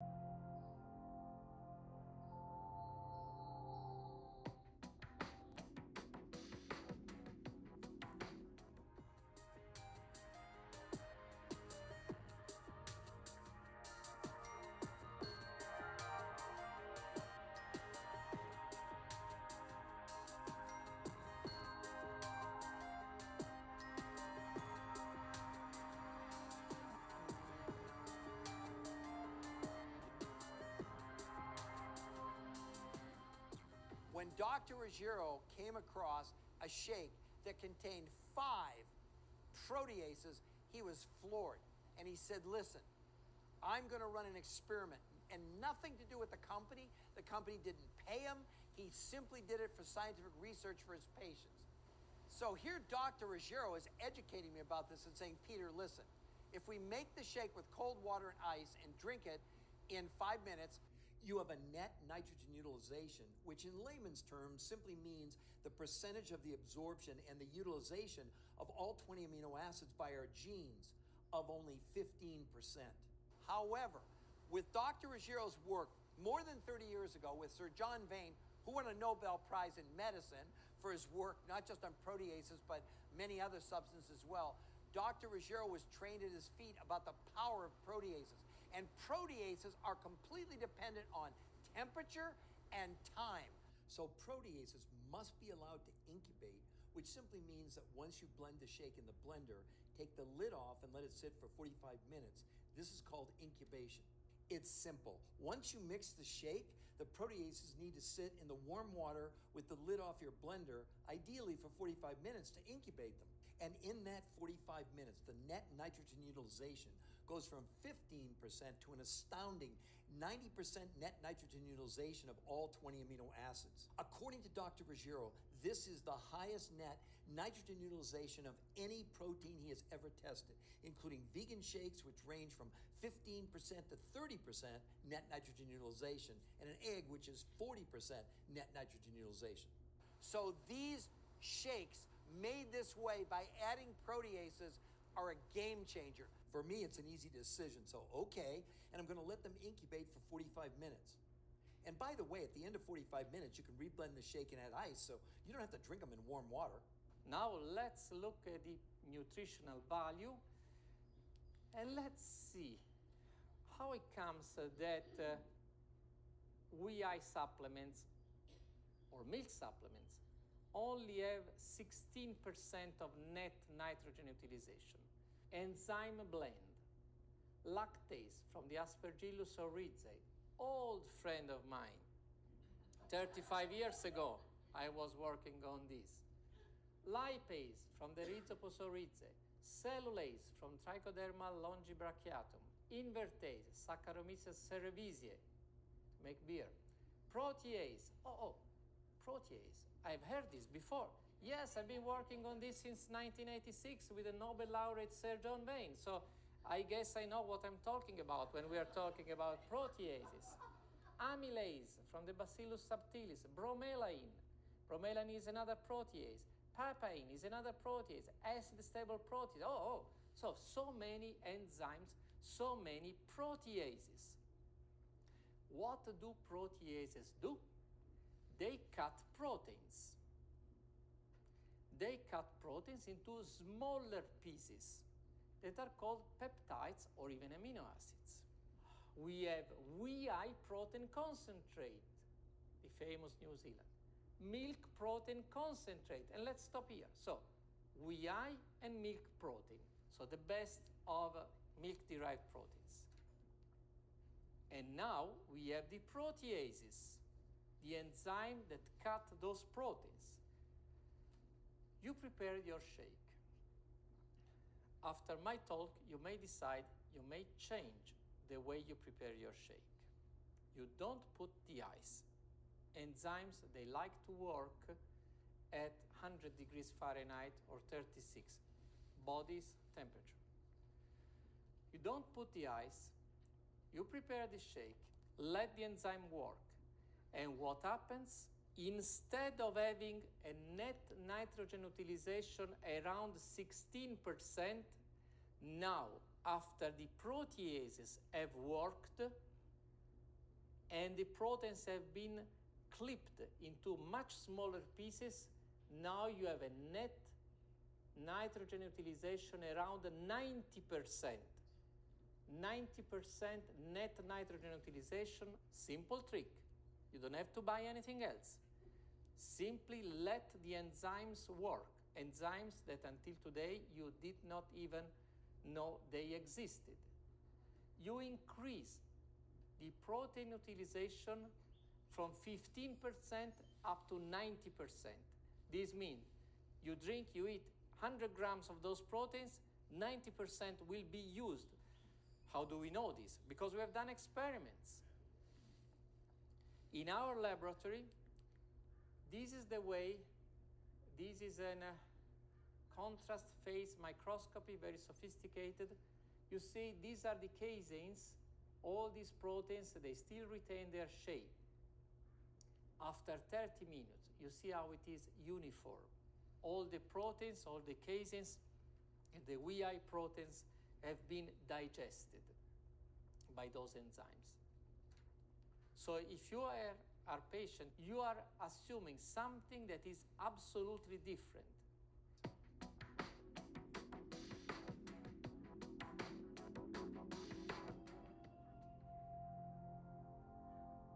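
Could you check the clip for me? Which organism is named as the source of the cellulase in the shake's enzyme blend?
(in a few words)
Trichoderma longibrachiatum.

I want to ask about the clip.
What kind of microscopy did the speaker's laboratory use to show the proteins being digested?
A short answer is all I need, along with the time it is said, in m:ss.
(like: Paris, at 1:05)
contrast phase microscopy, at 5:52.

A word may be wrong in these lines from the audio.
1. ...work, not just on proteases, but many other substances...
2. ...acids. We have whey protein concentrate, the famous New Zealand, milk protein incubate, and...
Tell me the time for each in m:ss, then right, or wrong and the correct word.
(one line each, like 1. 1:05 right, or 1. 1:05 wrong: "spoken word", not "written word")
1. 1:21 right
2. 3:57 wrong: "concentrate", not "incubate".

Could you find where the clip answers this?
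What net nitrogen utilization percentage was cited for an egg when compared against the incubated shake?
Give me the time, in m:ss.
2:17.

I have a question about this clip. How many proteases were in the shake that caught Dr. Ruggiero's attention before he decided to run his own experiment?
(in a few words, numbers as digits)
5.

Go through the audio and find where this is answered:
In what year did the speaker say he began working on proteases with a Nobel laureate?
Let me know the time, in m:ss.
3:23.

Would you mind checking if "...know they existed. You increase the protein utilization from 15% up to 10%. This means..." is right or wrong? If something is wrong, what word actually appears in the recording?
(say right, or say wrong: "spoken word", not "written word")
wrong: "90", not "10".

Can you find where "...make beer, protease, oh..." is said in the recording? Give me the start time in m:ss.
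3:16.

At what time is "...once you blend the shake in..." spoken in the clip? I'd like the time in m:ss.
1:37.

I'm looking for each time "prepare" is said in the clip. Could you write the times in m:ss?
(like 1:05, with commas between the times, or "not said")
4:22, 4:29, 4:44.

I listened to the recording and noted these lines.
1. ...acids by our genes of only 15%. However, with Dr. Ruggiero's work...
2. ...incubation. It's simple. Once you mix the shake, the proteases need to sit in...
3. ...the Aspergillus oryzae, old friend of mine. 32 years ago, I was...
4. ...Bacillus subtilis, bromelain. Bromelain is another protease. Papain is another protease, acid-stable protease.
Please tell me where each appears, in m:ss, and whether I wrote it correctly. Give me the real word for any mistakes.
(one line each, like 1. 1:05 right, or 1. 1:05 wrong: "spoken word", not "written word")
1. 1:09 right
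2. 1:43 right
3. 2:58 wrong: "35", not "32"
4. 3:32 right.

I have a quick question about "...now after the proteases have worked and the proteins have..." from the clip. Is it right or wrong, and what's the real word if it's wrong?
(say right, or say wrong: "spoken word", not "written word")
right.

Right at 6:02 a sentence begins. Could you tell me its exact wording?
After 30 minutes, you see how it is uniform.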